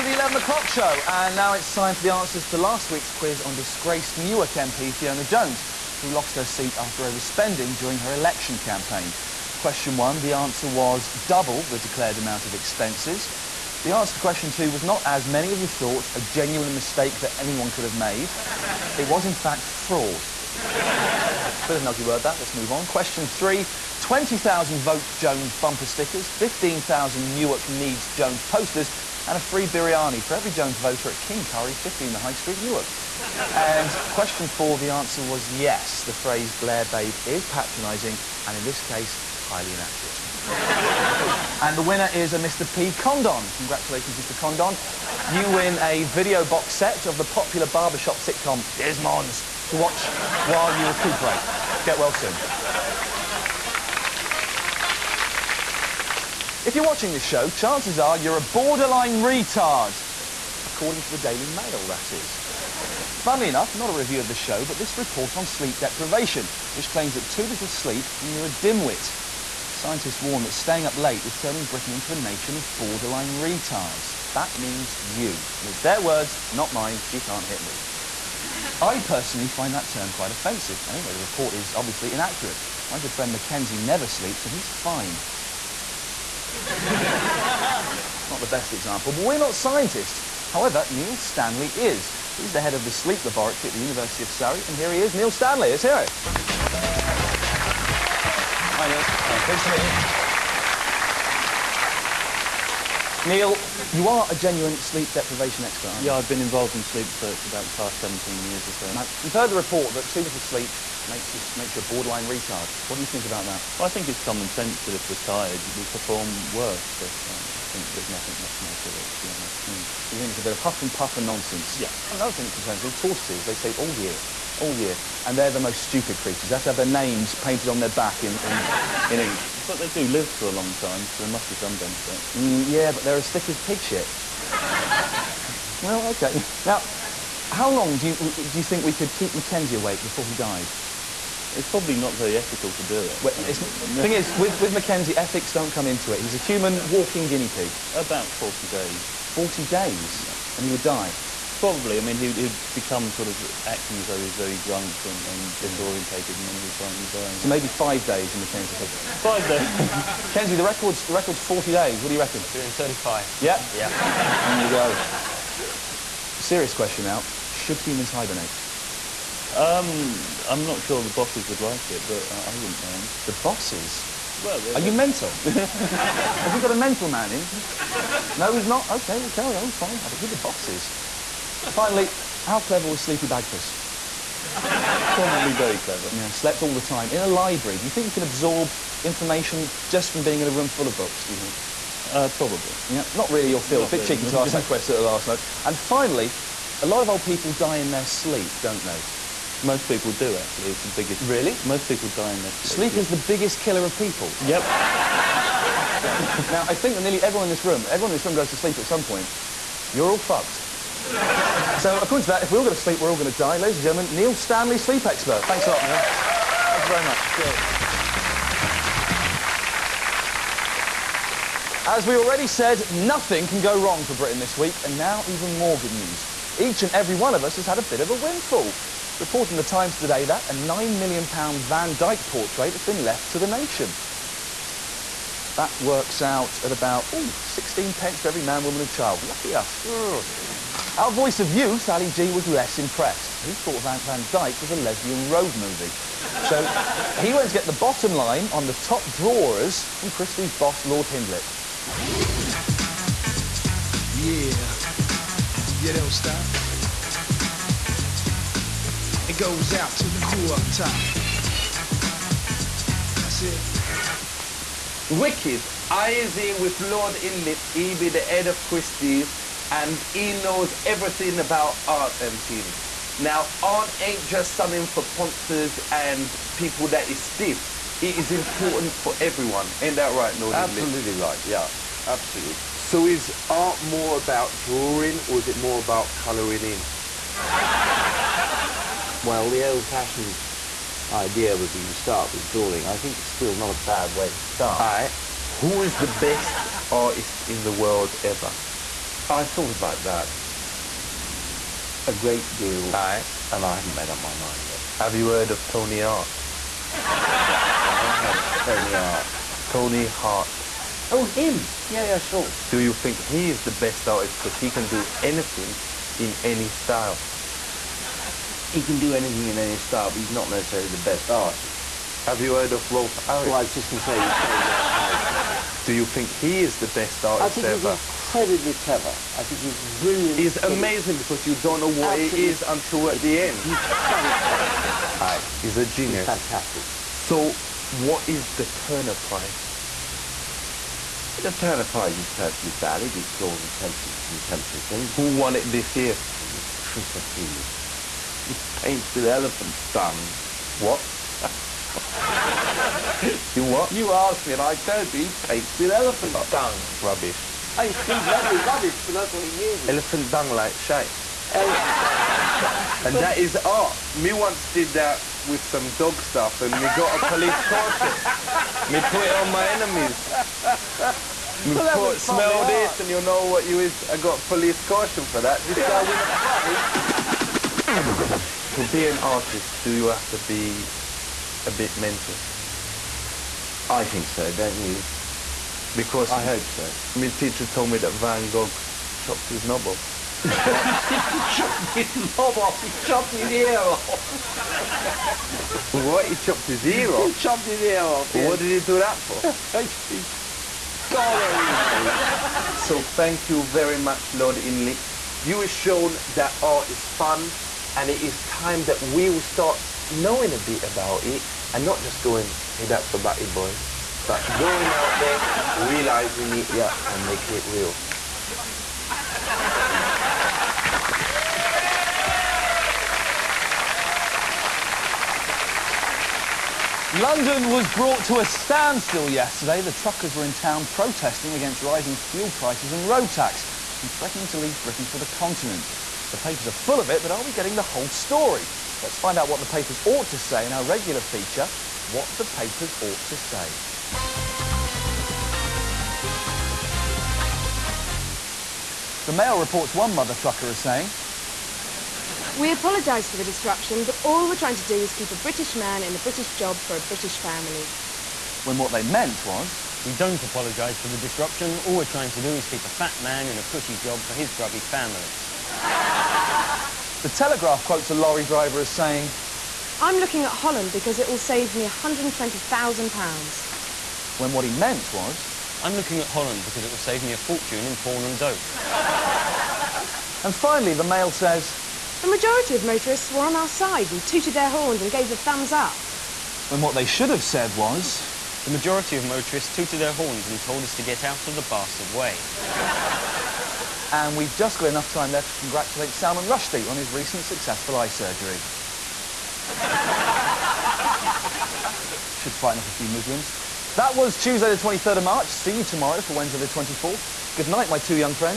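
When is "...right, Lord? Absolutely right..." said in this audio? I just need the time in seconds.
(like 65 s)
280 s.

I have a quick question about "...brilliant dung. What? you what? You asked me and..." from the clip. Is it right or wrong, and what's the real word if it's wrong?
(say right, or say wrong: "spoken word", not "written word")
wrong: "elephant", not "brilliant".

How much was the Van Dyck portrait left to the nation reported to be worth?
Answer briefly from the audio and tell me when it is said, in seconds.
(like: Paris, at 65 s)
£9 million, at 230 s.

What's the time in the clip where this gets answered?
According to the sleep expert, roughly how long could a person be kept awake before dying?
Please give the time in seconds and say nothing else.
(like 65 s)
147 s.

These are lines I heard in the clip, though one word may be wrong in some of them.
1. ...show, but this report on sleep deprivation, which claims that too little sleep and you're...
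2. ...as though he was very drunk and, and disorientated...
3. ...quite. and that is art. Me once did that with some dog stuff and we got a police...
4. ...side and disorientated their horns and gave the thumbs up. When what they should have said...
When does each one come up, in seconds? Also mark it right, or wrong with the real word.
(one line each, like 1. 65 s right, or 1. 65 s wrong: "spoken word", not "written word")
1. 64 s right
2. 153 s right
3. 360 s wrong: "shite", not "quite"
4. 483 s wrong: "tooted", not "disorientated".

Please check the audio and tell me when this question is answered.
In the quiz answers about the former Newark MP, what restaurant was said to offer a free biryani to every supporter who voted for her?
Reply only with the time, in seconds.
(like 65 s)
31 s.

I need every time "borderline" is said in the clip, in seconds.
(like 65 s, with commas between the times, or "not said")
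58 s, 72 s, 111 s.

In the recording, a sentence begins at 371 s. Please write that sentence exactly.
Me well, put, smell this and you'll know what you is.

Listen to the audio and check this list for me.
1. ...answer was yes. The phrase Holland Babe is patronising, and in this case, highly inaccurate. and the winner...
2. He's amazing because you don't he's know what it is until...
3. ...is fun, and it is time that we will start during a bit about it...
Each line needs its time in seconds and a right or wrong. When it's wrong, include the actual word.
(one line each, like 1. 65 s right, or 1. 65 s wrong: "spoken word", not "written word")
1. 34 s wrong: "Blair", not "Holland"
2. 330 s right
3. 406 s wrong: "knowing", not "during".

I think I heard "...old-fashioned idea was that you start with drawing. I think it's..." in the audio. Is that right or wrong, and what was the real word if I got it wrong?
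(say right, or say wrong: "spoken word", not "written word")
right.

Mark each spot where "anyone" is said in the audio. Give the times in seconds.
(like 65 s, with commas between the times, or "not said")
17 s.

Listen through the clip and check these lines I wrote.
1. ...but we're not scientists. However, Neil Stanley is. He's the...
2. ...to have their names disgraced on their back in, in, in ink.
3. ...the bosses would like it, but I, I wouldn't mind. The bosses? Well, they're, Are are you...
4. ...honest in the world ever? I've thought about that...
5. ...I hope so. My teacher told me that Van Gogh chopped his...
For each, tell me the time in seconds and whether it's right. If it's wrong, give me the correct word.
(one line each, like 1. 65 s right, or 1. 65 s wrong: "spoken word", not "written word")
1. 89 s right
2. 126 s wrong: "painted", not "disgraced"
3. 171 s right
4. 296 s wrong: "artist", not "honest"
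5. 386 s right.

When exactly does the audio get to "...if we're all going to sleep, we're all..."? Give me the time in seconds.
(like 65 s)
212 s.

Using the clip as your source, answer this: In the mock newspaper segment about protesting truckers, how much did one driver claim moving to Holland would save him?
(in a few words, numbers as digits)
£120,000.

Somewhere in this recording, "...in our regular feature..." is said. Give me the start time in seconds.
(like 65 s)
440 s.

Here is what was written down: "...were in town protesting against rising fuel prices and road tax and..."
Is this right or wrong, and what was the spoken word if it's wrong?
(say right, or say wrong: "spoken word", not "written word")
right.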